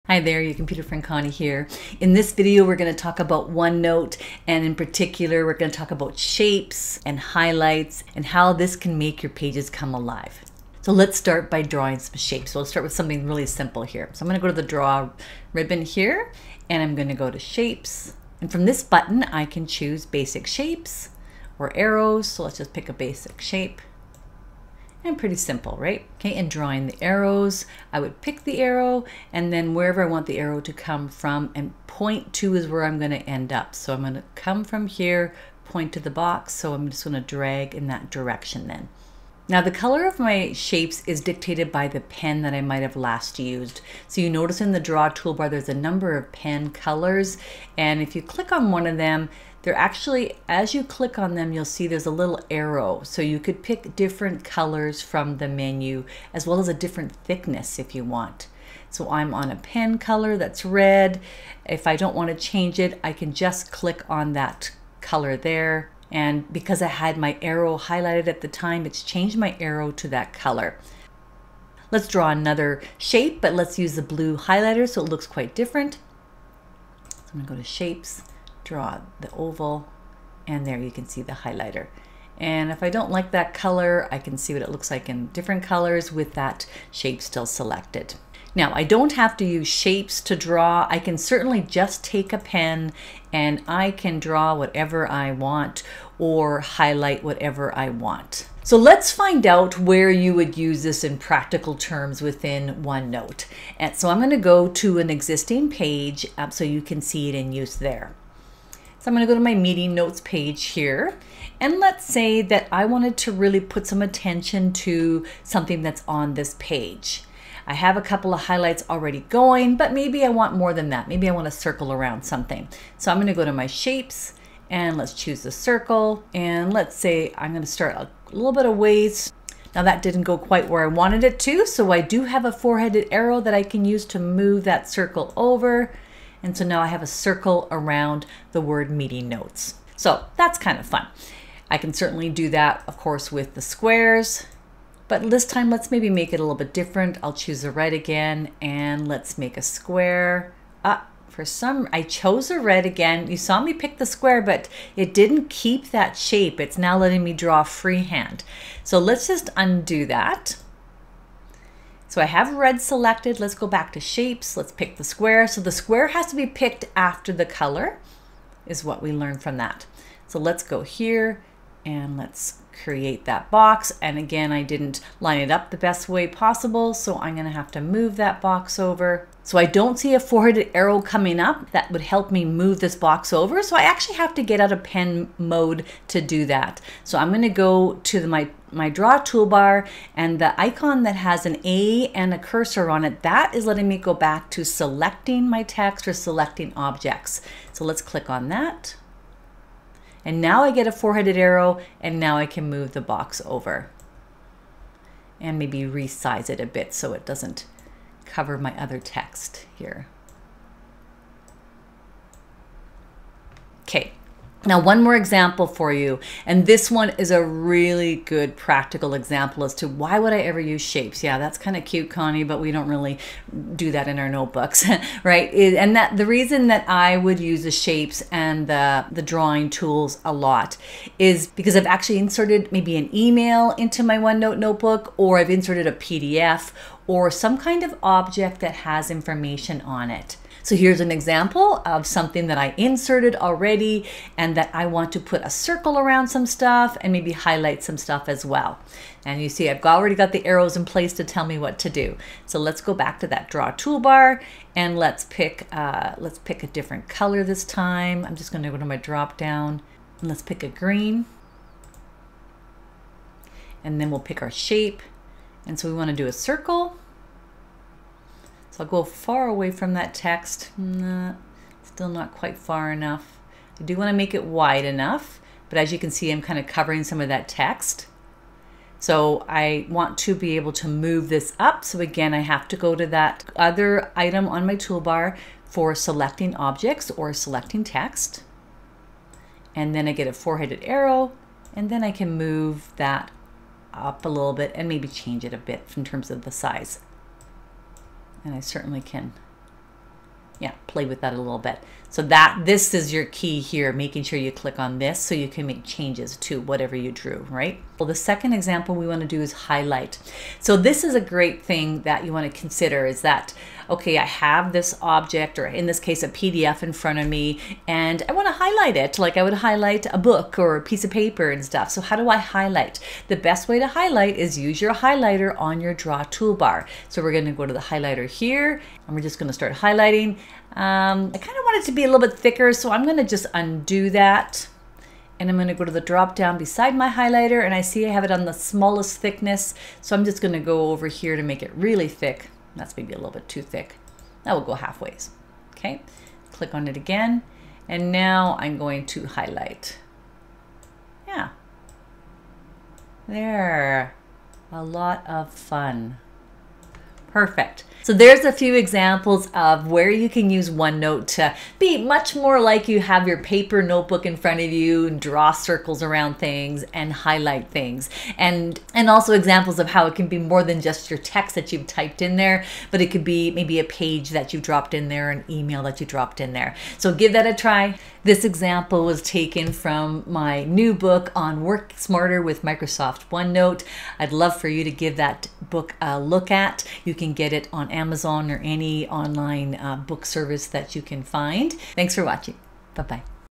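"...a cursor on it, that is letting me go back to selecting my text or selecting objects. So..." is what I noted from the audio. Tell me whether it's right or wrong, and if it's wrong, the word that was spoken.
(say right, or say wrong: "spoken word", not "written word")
right.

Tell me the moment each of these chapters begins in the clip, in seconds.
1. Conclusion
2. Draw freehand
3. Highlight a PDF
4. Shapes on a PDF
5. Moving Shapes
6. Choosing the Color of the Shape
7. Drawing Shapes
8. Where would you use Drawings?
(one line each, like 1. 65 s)
1. 356 s
2. 88 s
3. 307 s
4. 225 s
5. 174 s
6. 39 s
7. 12 s
8. 98 s.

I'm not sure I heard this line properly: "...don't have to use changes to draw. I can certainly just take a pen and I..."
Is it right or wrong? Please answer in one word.
wrong.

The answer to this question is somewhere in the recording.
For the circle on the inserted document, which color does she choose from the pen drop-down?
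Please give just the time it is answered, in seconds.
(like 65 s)
260 s.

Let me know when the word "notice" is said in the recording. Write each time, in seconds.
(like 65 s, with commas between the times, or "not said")
44 s.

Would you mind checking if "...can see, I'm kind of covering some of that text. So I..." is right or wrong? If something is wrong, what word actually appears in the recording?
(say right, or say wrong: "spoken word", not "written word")
right.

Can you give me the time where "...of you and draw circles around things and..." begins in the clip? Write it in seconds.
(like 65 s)
364 s.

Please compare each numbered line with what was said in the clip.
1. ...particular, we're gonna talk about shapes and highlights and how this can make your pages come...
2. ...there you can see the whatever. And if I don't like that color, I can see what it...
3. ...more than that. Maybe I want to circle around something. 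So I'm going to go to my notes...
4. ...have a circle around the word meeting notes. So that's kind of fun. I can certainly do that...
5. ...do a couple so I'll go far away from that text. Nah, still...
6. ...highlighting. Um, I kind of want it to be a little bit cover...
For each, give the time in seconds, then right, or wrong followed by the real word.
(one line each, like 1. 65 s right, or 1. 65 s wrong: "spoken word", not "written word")
1. 4 s right
2. 80 s wrong: "highlighter", not "whatever"
3. 120 s wrong: "shapes", not "notes"
4. 136 s right
5. 266 s wrong: "circle", not "couple"
6. 329 s wrong: "thicker", not "cover".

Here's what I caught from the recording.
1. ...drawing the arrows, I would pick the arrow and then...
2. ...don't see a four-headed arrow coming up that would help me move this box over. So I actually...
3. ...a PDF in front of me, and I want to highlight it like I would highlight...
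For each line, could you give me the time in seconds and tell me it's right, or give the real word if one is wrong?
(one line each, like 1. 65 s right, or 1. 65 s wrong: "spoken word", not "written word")
1. 26 s right
2. 179 s right
3. 316 s right.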